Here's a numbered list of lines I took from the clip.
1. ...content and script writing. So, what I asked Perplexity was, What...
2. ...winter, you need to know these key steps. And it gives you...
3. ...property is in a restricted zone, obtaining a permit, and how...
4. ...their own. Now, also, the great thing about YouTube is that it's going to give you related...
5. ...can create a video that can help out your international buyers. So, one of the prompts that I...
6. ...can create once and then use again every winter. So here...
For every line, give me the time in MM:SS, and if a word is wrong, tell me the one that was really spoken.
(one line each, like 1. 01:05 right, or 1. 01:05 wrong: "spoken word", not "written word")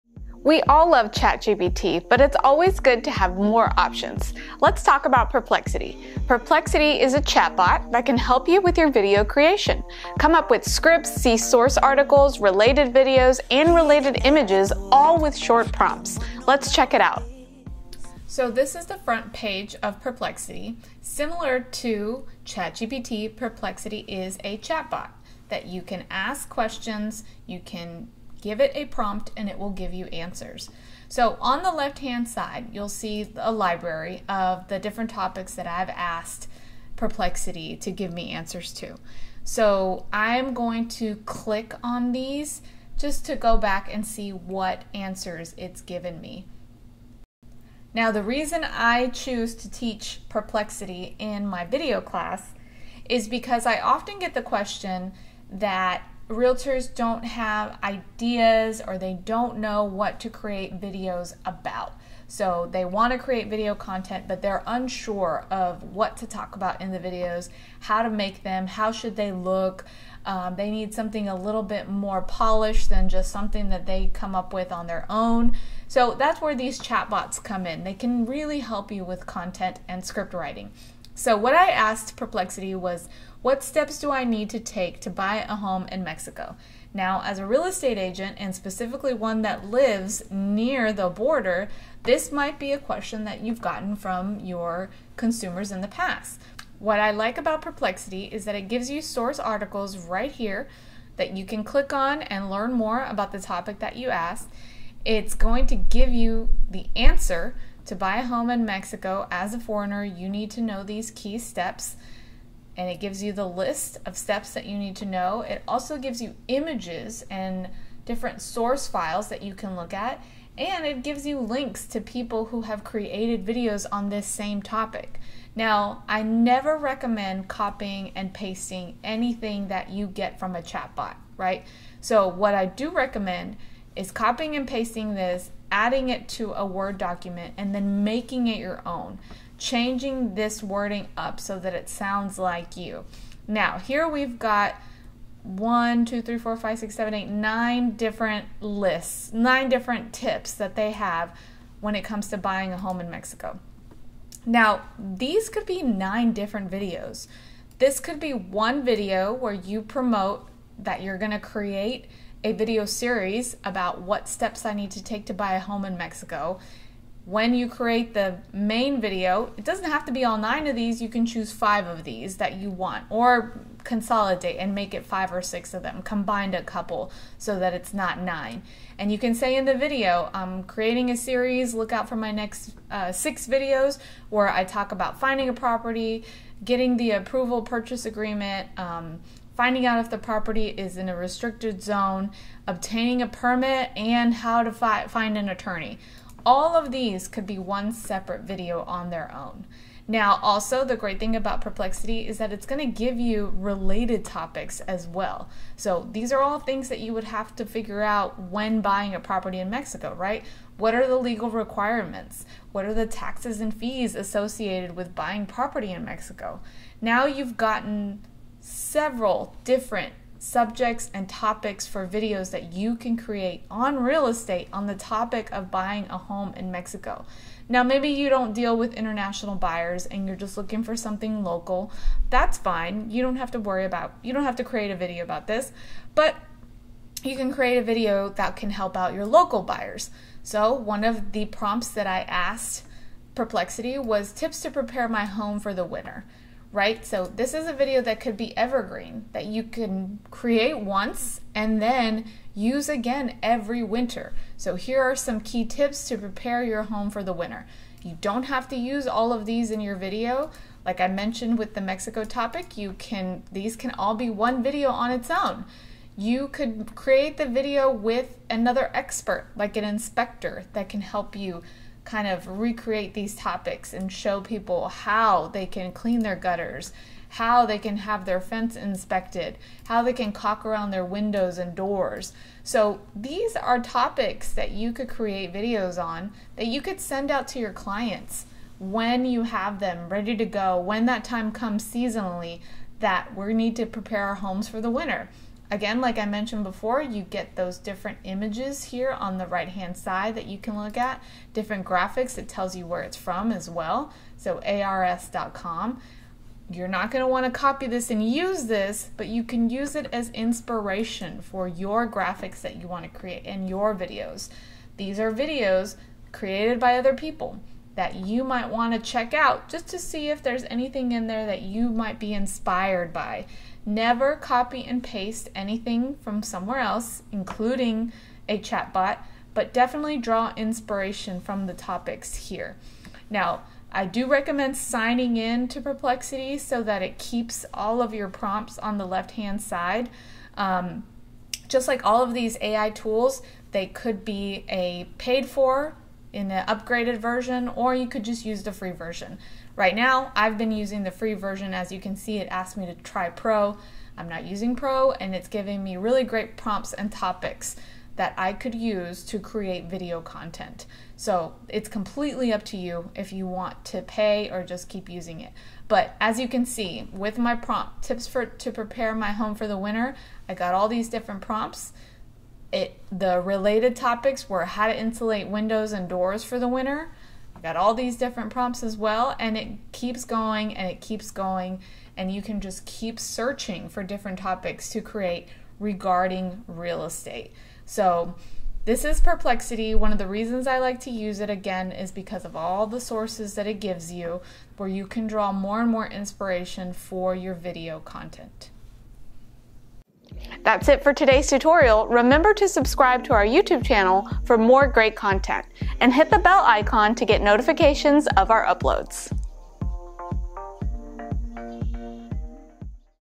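1. 01:19 right
2. 01:49 wrong: "foreigner", not "winter"
3. 03:10 right
4. 03:19 wrong: "Perplexity", not "YouTube"
5. 03:57 wrong: "local", not "international"
6. 04:09 right.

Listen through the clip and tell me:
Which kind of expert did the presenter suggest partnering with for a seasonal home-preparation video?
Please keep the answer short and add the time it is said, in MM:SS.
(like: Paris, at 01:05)
An inspector, at 04:29.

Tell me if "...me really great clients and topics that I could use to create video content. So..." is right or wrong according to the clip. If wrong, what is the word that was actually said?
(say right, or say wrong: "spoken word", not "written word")
wrong: "prompts", not "clients".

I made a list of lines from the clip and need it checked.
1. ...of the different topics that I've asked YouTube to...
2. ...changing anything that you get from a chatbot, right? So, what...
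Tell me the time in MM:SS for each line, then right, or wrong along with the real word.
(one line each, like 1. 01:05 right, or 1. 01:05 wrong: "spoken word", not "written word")
1. 00:34 wrong: "Perplexity", not "YouTube"
2. 02:08 wrong: "pasting", not "changing".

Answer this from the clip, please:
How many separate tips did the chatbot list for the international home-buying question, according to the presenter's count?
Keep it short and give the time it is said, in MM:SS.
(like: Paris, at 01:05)
9, at 02:29.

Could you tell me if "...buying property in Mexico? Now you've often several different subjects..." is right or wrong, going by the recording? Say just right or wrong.
wrong.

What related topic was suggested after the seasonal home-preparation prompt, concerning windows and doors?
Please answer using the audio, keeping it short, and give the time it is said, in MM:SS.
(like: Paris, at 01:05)
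How to insulate windows and doors, at 06:14.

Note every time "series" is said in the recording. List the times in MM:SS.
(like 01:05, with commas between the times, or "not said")
02:42, 03:01.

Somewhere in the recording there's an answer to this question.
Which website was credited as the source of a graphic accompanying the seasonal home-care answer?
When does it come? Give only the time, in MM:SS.
05:04.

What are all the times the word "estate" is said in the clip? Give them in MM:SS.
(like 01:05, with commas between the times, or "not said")
01:27, 03:44, 06:27.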